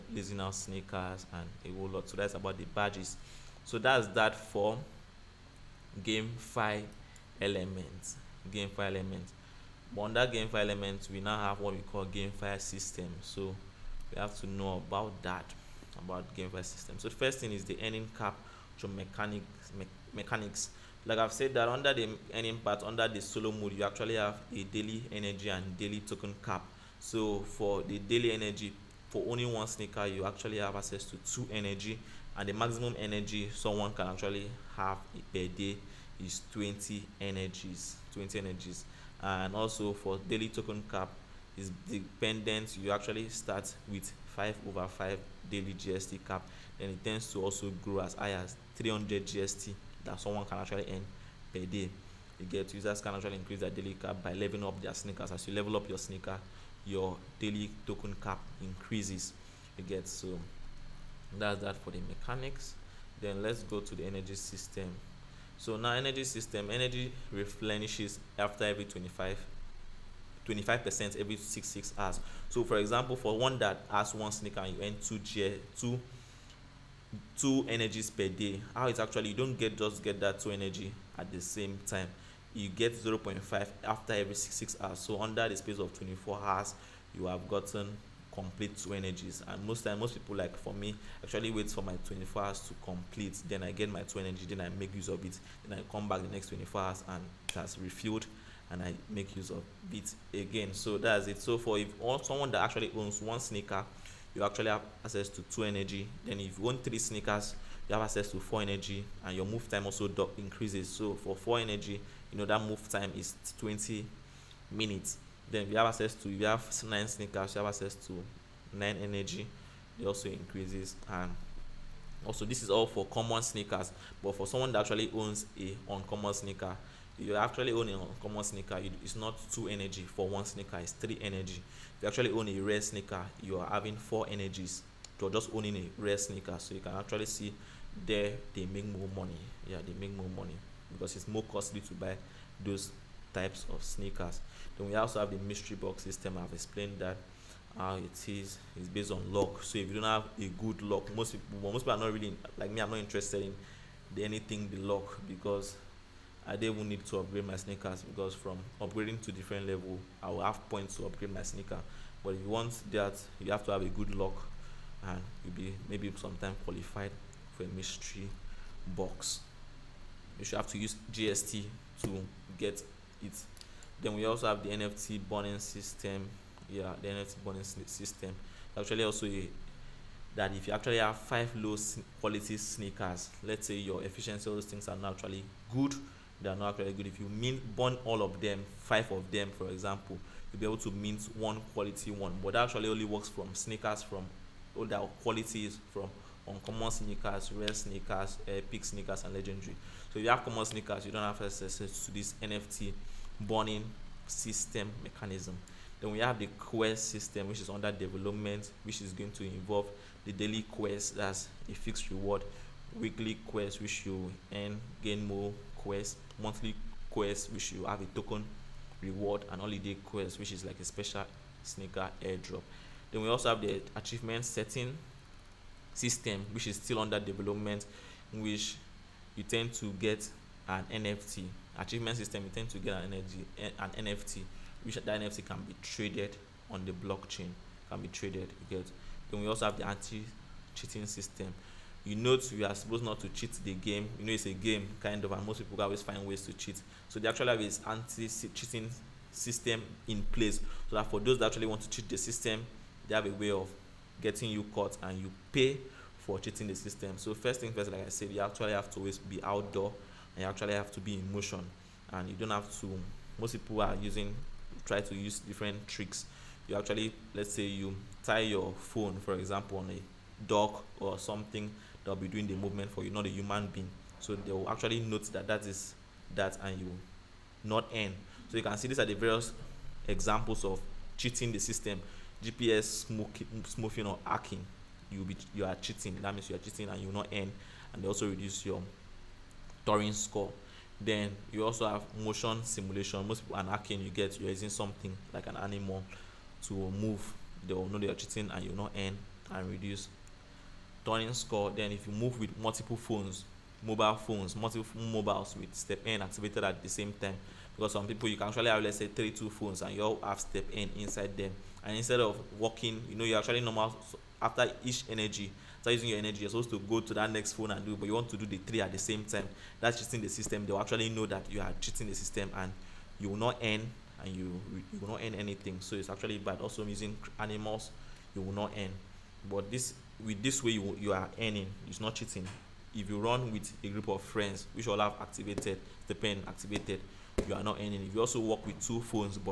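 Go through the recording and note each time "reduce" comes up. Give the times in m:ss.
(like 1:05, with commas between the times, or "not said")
4:48, 4:59.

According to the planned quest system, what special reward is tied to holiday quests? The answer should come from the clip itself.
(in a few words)
special sneaker airdrop.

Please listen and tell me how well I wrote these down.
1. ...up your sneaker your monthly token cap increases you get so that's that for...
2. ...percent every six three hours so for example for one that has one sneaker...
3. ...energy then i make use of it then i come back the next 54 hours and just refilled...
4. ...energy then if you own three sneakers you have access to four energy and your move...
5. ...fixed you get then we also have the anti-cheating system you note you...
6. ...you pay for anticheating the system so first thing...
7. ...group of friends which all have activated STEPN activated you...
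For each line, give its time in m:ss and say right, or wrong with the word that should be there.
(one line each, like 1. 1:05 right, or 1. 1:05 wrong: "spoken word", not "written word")
1. 0:55 wrong: "daily", not "monthly"
2. 1:10 wrong: "six", not "three"
3. 1:34 wrong: "24", not "54"
4. 1:45 right
5. 3:58 wrong: "traded", not "fixed"
6. 4:15 wrong: "cheating", not "anticheating"
7. 5:33 right.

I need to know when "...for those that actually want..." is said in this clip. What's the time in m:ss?
4:11.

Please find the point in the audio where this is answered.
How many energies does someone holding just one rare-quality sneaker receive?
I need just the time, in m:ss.
2:13.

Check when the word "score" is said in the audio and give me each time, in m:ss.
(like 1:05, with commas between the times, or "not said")
4:50, 5:01.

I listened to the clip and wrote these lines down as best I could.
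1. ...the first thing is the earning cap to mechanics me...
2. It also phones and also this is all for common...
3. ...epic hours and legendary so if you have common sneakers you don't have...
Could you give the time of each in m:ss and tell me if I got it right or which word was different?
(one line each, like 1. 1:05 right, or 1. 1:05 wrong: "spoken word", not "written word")
1. 0:17 right
2. 2:00 wrong: "increases", not "phones"
3. 3:18 wrong: "sneakers", not "hours".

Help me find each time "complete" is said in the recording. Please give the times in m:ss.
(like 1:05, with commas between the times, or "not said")
1:28, 1:32.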